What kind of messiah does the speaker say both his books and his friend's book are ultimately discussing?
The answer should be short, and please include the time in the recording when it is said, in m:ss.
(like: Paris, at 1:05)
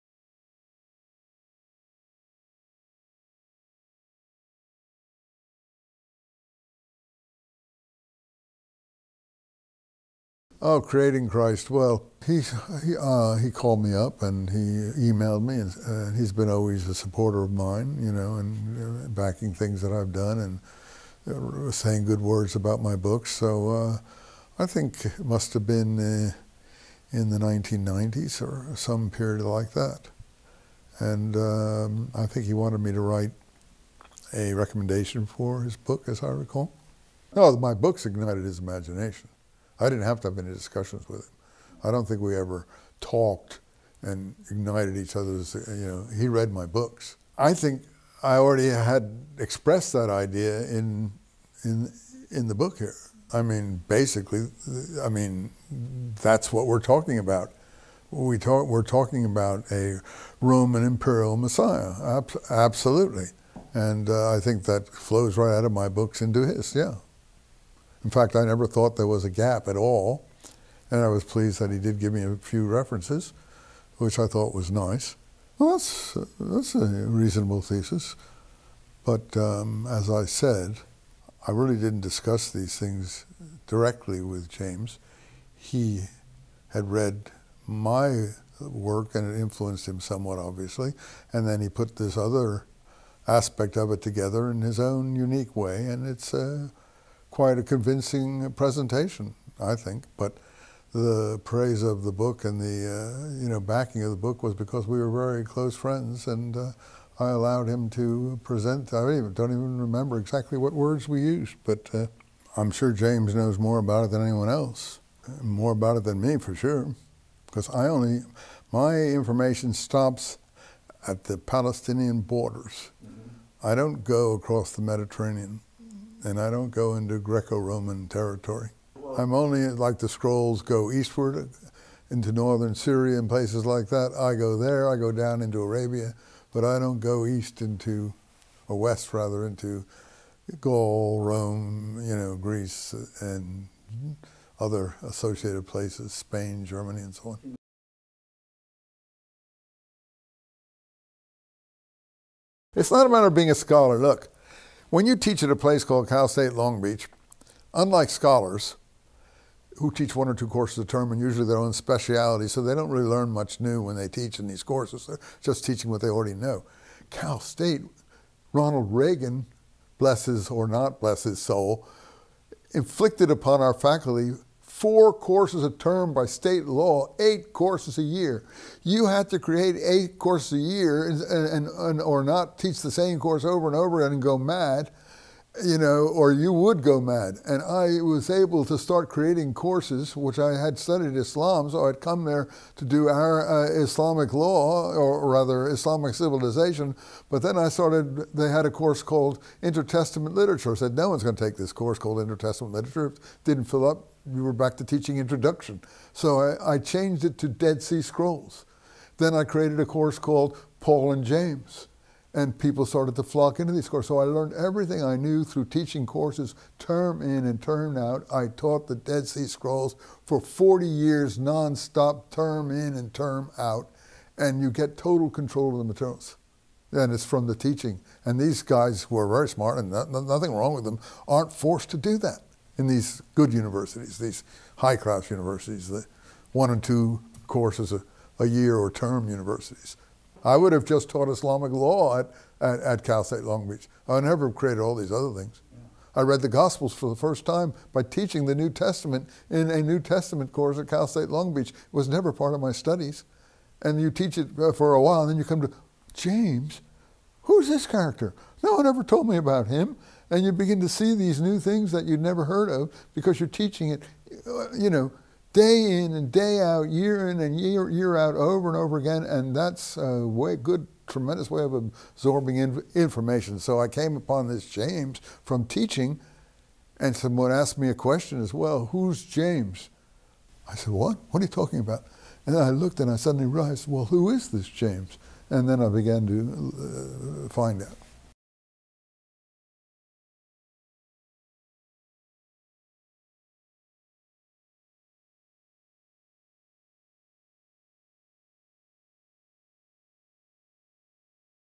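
Roman imperial messiah, at 1:00.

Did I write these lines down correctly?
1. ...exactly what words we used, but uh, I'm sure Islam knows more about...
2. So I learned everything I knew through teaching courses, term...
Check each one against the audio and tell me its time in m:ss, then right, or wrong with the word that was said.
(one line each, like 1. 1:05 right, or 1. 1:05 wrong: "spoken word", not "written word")
1. 1:50 wrong: "James", not "Islam"
2. 3:34 right.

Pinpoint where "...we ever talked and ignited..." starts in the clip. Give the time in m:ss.
0:42.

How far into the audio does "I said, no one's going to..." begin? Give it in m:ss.
3:20.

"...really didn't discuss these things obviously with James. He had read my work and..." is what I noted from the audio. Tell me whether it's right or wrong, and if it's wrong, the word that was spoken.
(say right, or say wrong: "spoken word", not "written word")
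wrong: "directly", not "obviously".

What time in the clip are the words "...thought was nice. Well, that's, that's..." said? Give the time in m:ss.
1:14.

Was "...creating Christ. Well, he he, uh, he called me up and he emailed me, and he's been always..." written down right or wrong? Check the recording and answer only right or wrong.
right.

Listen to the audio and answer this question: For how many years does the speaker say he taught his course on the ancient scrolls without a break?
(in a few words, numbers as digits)
40.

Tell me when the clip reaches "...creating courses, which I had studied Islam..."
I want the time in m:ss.
3:09.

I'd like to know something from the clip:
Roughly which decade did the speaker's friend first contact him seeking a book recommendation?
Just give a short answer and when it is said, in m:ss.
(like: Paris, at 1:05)
1990s, at 0:27.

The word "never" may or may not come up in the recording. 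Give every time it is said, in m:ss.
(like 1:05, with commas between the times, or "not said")
1:08, 4:04, 4:12, 4:22.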